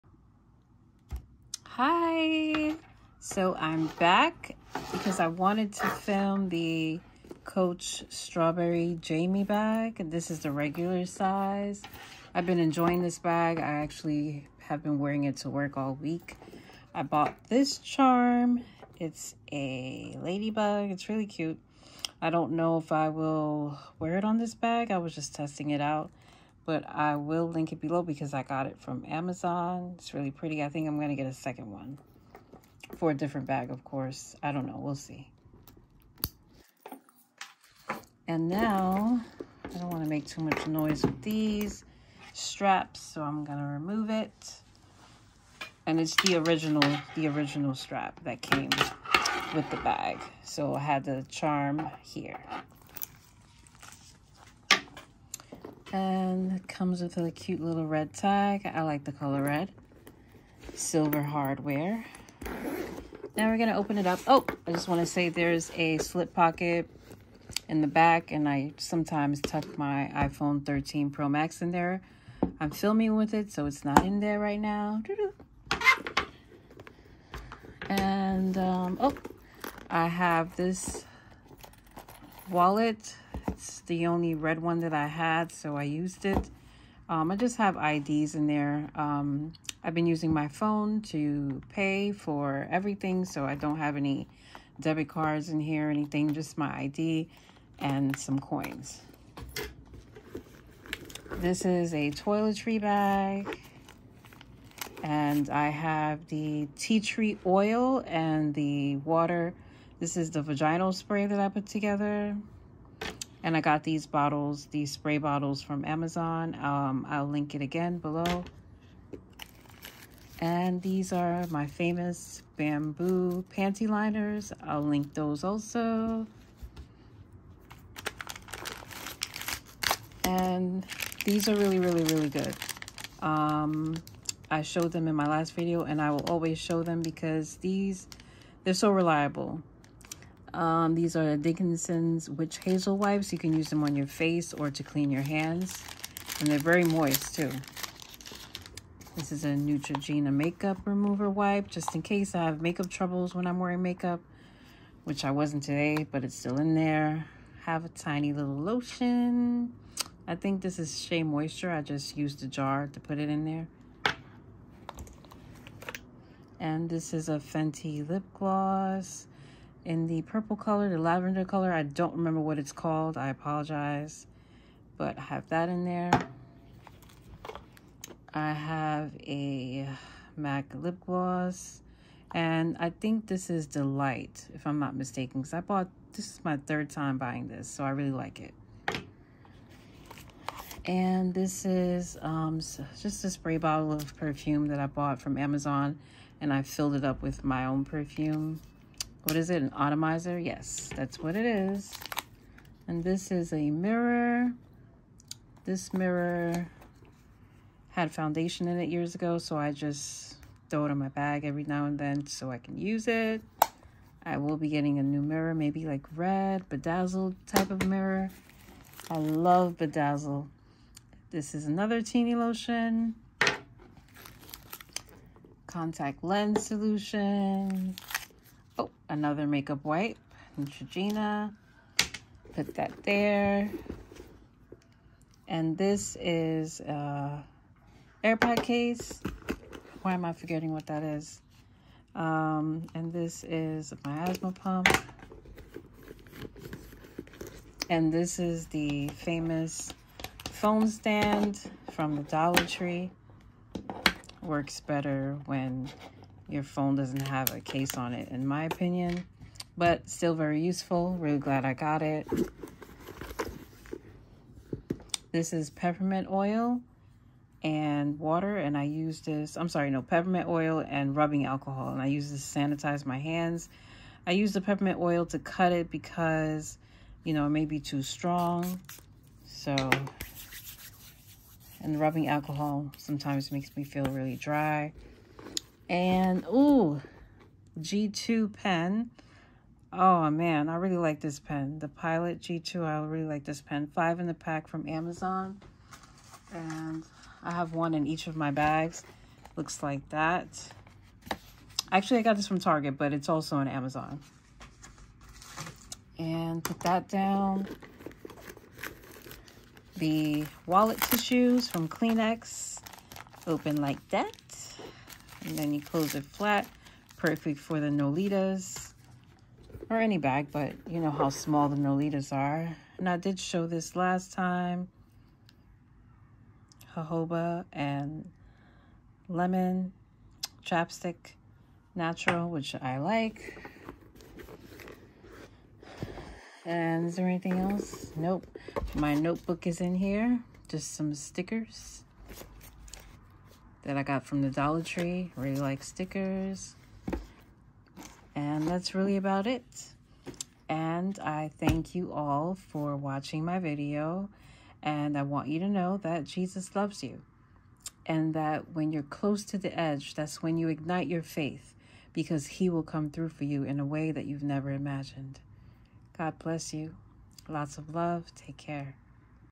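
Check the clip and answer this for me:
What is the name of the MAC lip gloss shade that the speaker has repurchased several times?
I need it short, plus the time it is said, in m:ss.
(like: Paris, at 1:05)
Delight, at 3:03.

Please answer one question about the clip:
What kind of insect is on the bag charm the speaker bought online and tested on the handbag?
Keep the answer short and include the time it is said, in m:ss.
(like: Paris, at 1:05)
Ladybug, at 0:20.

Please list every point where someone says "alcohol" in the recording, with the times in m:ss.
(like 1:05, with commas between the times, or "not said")
4:31, 4:42.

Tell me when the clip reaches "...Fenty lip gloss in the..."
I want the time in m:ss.
2:47.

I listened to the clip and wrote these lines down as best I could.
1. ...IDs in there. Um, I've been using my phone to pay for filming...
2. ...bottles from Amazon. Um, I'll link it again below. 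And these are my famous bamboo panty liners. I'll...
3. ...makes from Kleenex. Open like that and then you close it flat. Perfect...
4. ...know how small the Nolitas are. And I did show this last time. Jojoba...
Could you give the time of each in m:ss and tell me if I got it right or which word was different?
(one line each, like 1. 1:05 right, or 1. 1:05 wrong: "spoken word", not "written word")
1. 1:27 wrong: "everything", not "filming"
2. 1:55 right
3. 5:11 wrong: "tissues", not "makes"
4. 5:20 right.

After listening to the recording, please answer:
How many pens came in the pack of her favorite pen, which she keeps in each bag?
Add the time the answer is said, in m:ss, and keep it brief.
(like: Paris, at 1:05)
5, at 4:53.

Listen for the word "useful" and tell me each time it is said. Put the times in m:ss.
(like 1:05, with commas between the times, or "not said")
4:20.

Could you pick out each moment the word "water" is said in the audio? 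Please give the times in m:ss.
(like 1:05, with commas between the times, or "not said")
1:48, 4:28.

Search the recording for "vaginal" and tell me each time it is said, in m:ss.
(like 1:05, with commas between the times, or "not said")
1:50.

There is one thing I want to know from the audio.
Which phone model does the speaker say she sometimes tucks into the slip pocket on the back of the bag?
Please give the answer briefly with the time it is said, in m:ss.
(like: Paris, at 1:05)
iPhone 13 Pro Max, at 1:10.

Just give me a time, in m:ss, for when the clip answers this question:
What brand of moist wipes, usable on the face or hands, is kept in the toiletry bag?
2:21.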